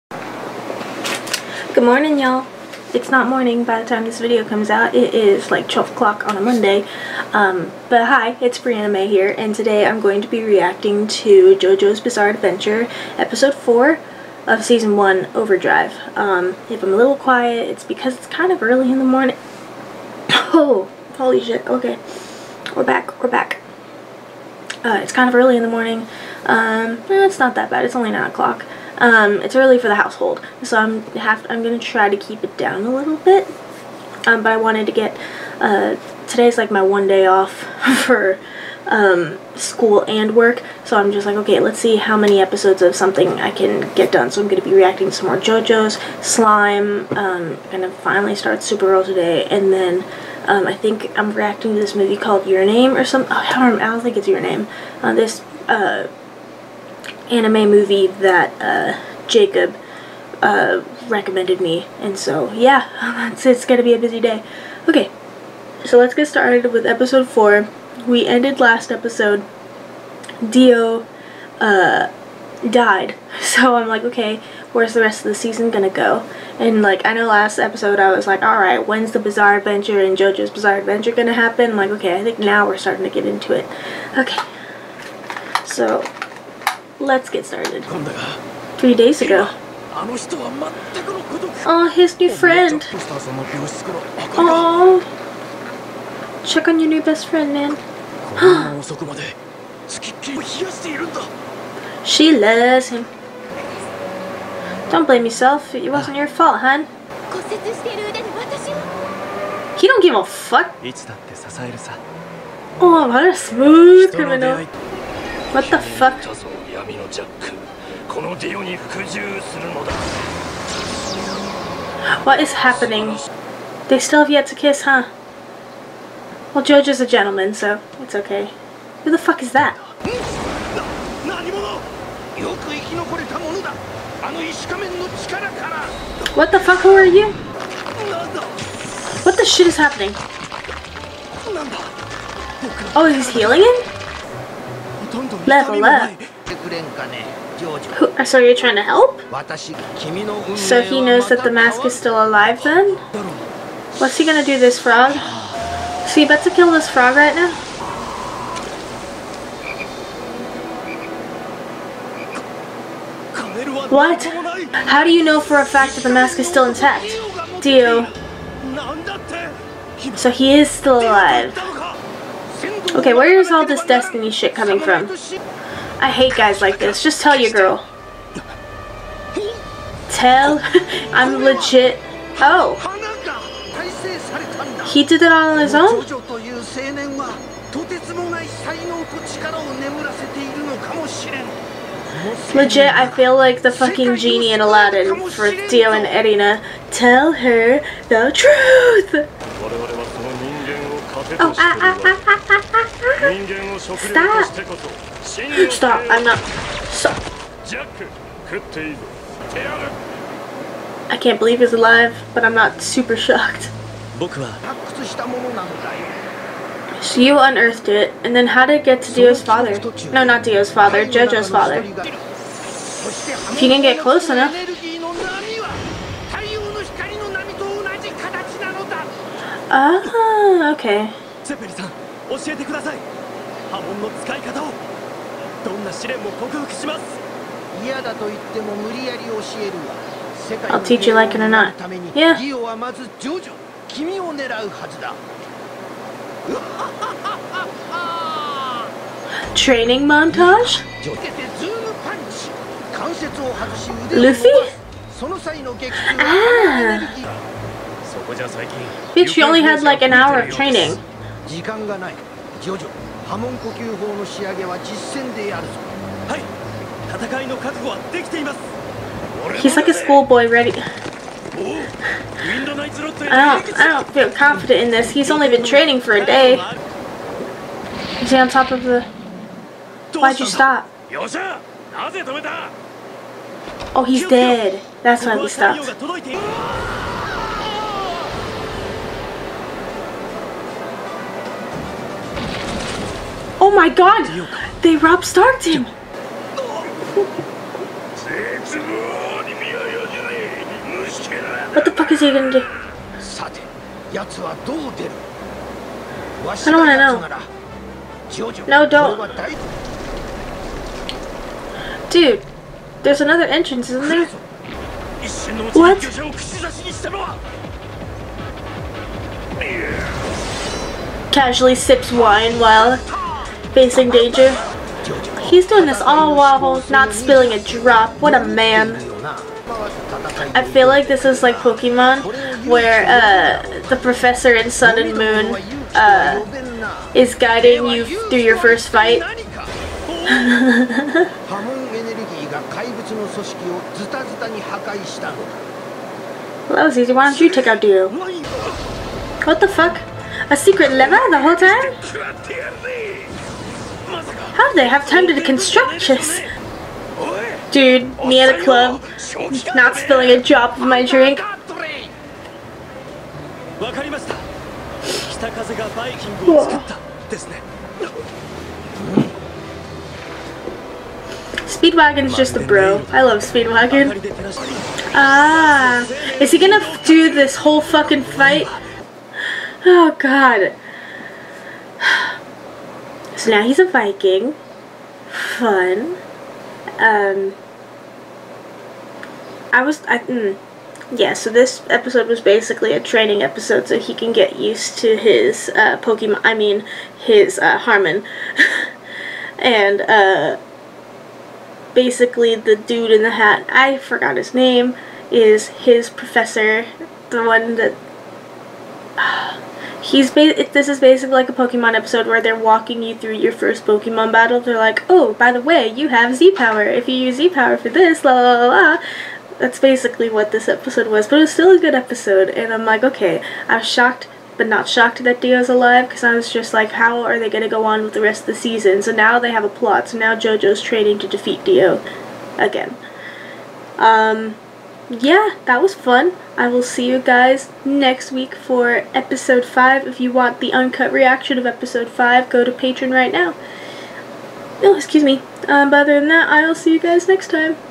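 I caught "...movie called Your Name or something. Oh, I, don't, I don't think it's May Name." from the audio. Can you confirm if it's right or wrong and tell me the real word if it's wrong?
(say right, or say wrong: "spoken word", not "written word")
wrong: "Your", not "May".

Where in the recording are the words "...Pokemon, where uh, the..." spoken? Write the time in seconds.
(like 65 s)
331 s.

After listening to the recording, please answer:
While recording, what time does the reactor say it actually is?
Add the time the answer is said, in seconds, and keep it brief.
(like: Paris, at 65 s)
9 o'clock, at 28 s.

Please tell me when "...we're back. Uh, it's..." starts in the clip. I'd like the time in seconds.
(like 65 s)
23 s.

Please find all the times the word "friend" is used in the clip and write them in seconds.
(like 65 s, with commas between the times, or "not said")
92 s, 97 s.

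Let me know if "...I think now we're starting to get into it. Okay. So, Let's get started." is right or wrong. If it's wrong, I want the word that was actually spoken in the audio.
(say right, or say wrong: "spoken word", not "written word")
right.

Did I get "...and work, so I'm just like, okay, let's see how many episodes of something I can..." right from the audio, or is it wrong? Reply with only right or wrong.
right.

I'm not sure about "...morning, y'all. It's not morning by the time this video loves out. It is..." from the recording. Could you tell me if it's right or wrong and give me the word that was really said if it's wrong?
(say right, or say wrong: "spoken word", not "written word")
wrong: "comes", not "loves".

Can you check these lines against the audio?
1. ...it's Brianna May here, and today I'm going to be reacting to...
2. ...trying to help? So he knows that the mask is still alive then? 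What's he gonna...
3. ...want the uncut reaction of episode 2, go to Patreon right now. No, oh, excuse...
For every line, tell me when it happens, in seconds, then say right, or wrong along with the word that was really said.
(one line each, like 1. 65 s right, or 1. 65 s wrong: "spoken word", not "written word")
1. 8 s right
2. 148 s right
3. 440 s wrong: "5", not "2".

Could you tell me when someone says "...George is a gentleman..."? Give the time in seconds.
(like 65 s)
126 s.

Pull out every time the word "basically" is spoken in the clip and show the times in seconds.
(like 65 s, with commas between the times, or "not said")
392 s, 401 s, 410 s, 419 s.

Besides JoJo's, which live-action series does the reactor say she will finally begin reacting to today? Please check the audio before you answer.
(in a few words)
Supergirl.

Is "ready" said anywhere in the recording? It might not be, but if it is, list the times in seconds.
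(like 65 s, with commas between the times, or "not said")
270 s.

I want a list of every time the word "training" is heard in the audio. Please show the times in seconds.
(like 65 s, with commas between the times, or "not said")
249 s, 260 s, 275 s, 392 s, 430 s.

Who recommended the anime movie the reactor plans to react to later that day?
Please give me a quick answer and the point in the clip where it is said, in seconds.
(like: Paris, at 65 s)
Jacob, at 59 s.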